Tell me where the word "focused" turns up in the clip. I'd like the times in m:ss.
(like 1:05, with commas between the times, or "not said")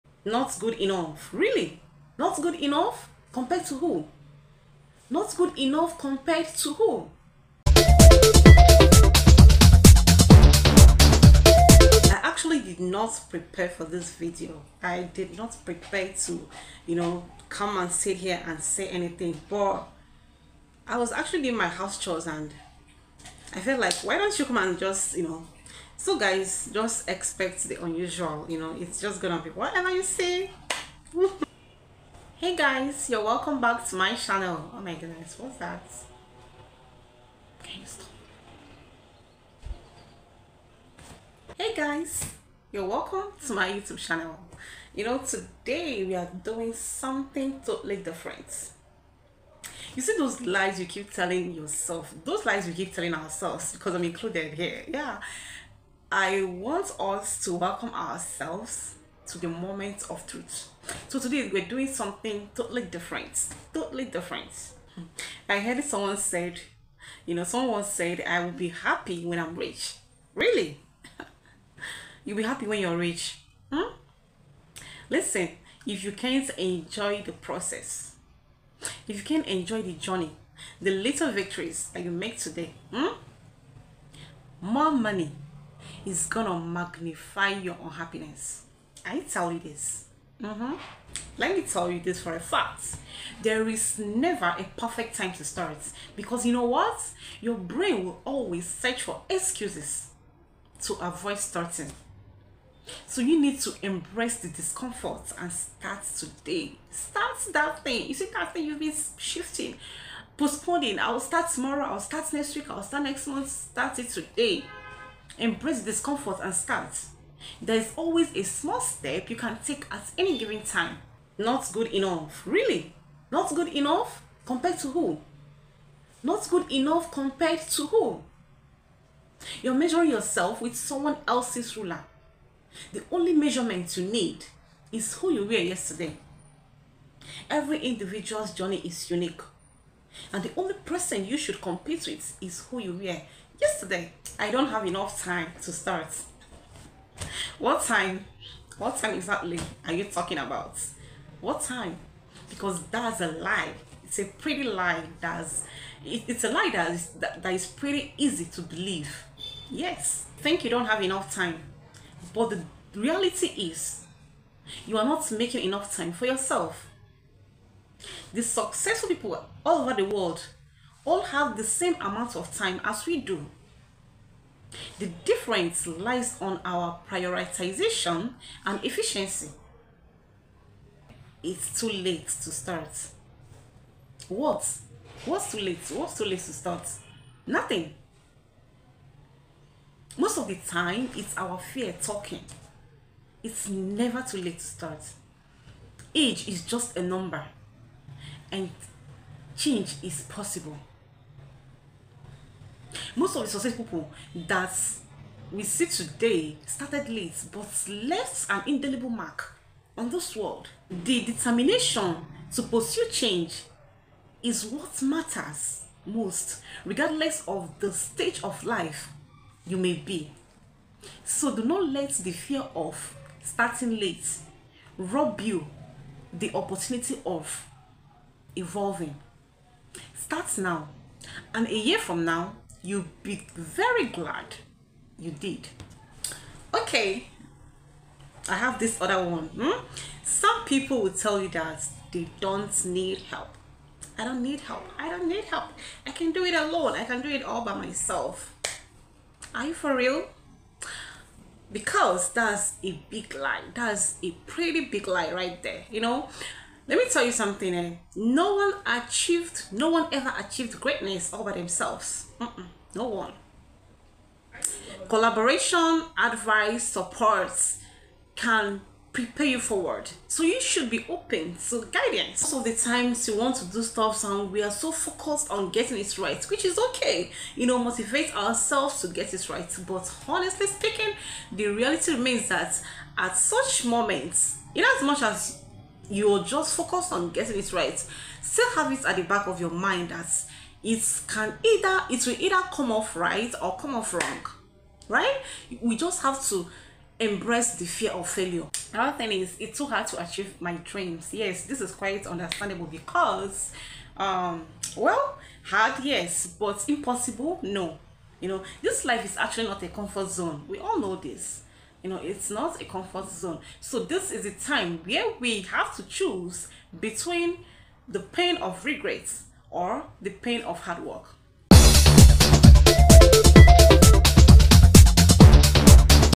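4:34, 4:46.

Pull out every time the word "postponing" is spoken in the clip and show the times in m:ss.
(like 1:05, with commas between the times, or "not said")
1:50.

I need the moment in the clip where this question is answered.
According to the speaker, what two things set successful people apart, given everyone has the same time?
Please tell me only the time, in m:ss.
2:57.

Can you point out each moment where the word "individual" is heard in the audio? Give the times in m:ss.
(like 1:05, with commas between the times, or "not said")
2:17.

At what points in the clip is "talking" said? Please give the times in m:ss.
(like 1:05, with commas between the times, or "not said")
2:30, 3:12.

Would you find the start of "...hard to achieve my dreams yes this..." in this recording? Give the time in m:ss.
4:59.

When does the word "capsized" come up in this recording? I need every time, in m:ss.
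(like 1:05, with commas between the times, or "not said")
not said.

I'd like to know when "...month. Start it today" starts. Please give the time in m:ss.
1:53.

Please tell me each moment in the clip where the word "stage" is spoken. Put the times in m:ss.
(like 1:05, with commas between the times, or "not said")
3:37.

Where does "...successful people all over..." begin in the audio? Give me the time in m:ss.
2:48.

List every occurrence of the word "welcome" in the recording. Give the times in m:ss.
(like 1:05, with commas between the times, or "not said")
0:33, 0:42, 0:57.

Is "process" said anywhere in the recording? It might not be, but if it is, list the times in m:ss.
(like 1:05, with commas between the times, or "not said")
1:17.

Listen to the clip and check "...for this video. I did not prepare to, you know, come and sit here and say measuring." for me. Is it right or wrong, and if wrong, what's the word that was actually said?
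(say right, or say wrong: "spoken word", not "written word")
wrong: "anything", not "measuring".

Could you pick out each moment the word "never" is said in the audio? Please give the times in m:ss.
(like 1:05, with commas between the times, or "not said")
1:33, 3:13.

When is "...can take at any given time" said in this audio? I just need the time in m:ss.
1:59.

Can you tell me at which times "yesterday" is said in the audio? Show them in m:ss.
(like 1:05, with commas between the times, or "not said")
2:15, 2:23.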